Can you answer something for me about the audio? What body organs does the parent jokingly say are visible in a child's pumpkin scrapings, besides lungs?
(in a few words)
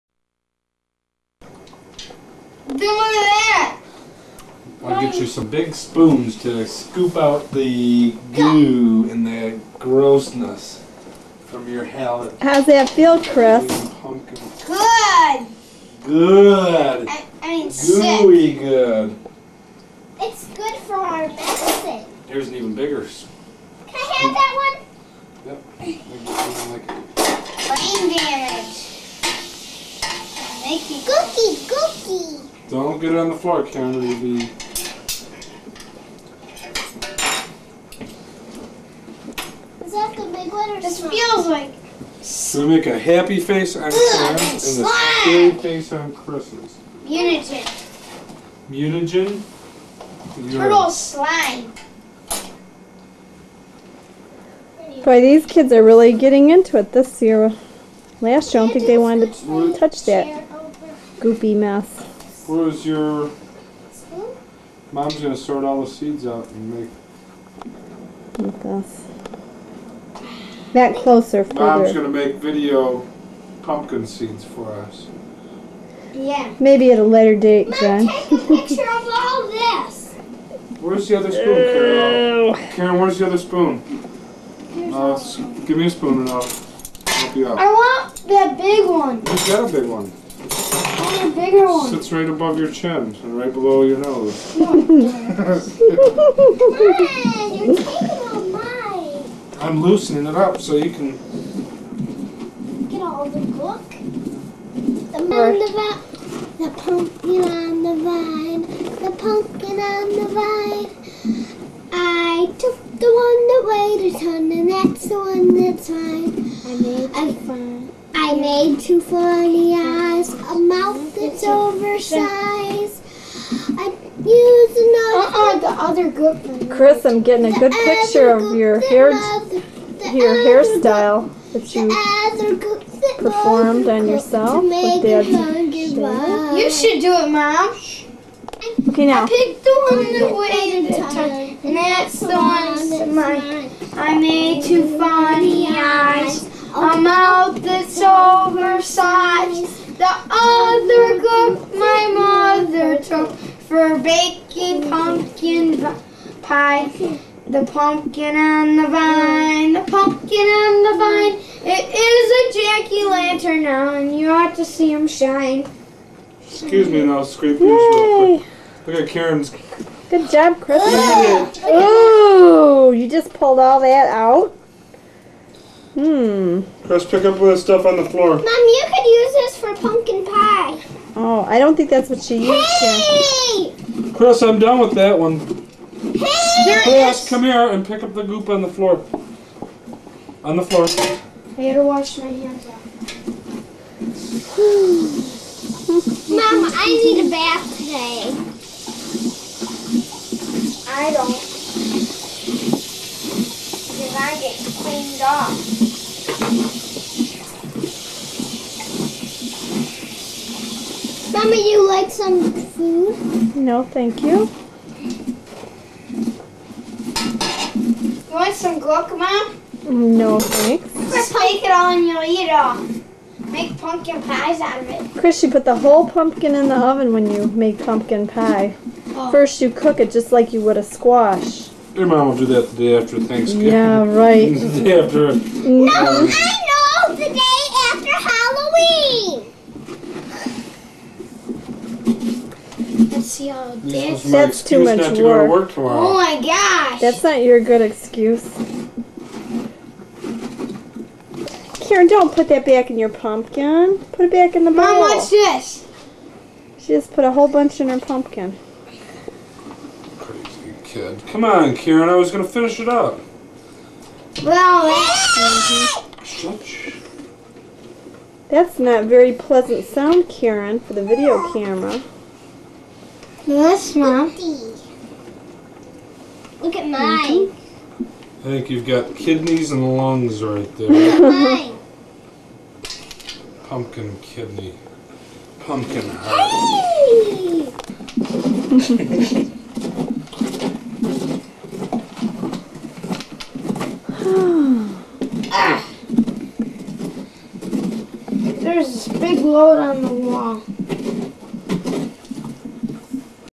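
kidneys.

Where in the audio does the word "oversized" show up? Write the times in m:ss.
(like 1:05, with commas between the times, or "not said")
2:02, 2:28.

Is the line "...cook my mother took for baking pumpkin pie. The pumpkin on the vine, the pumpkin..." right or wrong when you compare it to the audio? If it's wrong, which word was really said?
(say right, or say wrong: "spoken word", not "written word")
right.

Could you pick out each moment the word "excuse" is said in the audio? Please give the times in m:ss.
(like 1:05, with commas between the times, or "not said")
2:46, 4:07.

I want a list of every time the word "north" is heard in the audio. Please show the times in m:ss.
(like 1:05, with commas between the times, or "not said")
not said.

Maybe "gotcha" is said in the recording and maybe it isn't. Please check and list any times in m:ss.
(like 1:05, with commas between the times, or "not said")
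not said.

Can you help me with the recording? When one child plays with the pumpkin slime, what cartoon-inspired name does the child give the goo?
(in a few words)
Turtle slime.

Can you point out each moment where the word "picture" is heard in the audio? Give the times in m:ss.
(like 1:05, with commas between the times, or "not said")
1:18, 2:07.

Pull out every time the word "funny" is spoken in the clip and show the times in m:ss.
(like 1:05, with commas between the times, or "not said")
1:59, 2:24.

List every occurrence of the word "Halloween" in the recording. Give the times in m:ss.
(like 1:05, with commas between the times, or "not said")
4:02.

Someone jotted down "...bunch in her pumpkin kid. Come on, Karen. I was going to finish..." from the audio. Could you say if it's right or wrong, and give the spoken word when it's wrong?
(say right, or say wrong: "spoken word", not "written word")
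right.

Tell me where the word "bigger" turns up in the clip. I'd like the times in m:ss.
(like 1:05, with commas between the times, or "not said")
0:22, 1:31.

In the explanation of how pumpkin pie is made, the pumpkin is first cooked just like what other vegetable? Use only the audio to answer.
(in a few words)
squash.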